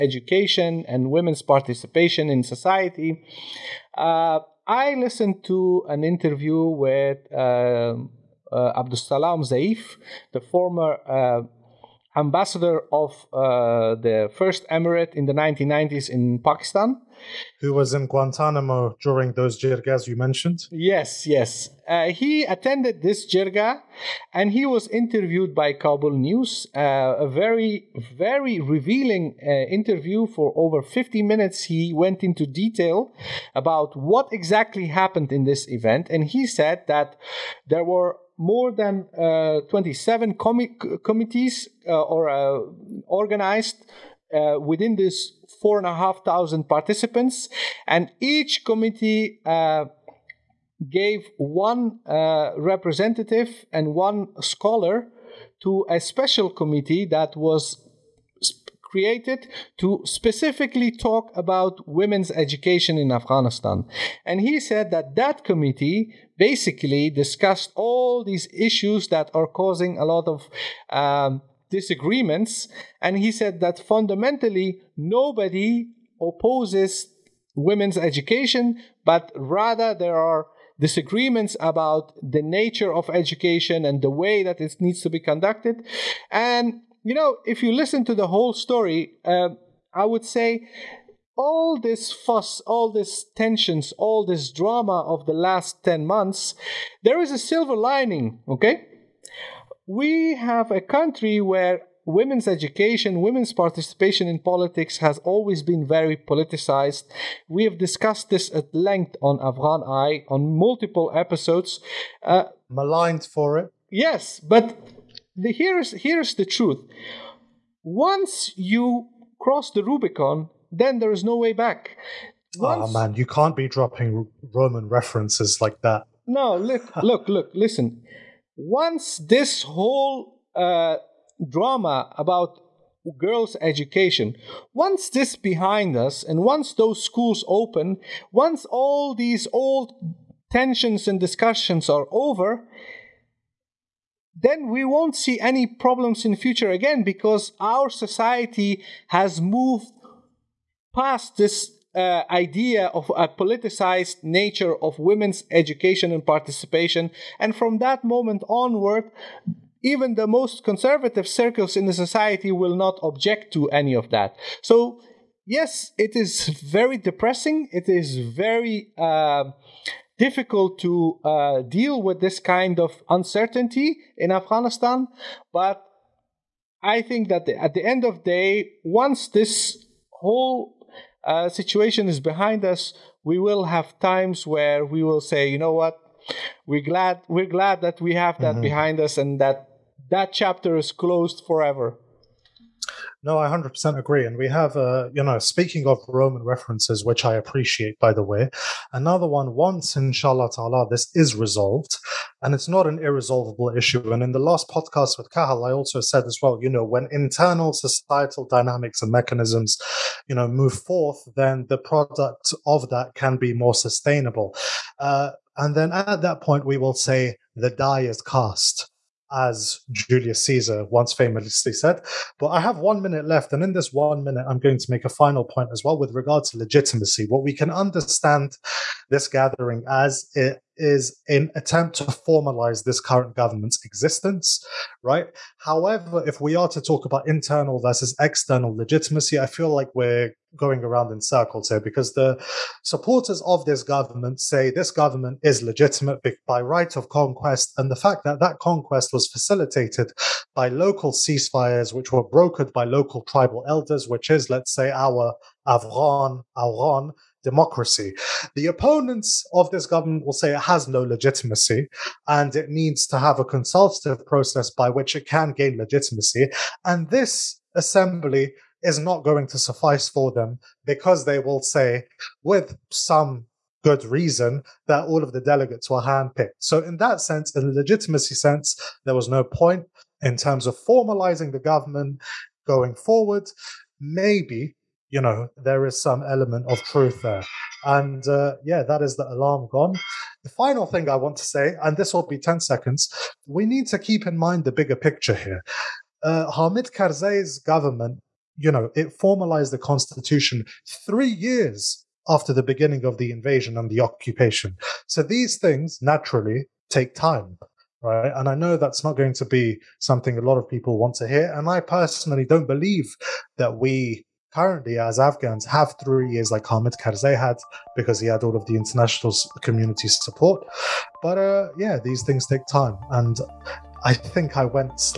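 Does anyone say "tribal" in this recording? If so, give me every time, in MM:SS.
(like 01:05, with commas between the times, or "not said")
04:13.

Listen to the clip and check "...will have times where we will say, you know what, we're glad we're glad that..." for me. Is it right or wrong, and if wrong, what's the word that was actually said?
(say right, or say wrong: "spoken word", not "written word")
right.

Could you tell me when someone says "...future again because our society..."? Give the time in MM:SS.
02:26.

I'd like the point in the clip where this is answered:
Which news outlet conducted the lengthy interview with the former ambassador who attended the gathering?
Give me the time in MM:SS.
00:25.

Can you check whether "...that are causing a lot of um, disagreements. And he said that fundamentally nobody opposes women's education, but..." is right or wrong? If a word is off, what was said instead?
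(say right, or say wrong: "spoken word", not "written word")
right.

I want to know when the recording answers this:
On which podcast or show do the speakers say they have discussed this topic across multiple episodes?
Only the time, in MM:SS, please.
01:49.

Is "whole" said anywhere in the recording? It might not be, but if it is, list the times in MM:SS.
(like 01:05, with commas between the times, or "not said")
01:28, 02:09, 03:00.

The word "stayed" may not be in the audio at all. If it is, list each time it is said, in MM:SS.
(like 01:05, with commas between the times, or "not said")
not said.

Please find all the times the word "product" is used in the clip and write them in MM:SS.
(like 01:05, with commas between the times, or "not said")
03:31.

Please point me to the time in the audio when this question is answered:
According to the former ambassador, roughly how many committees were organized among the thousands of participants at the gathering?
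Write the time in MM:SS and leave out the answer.
00:39.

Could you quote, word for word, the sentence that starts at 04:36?
So, in that sense, in the legitimacy sense, there was no point in terms of formalizing the government going forward.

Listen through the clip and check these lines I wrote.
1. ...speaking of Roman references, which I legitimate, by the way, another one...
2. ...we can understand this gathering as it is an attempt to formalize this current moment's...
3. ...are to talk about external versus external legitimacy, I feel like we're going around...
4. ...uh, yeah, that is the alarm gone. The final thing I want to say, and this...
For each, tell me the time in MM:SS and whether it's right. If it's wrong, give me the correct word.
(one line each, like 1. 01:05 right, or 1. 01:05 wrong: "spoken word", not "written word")
1. 03:15 wrong: "appreciate", not "legitimate"
2. 03:47 wrong: "government", not "moment"
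3. 03:56 wrong: "internal", not "external"
4. 04:48 right.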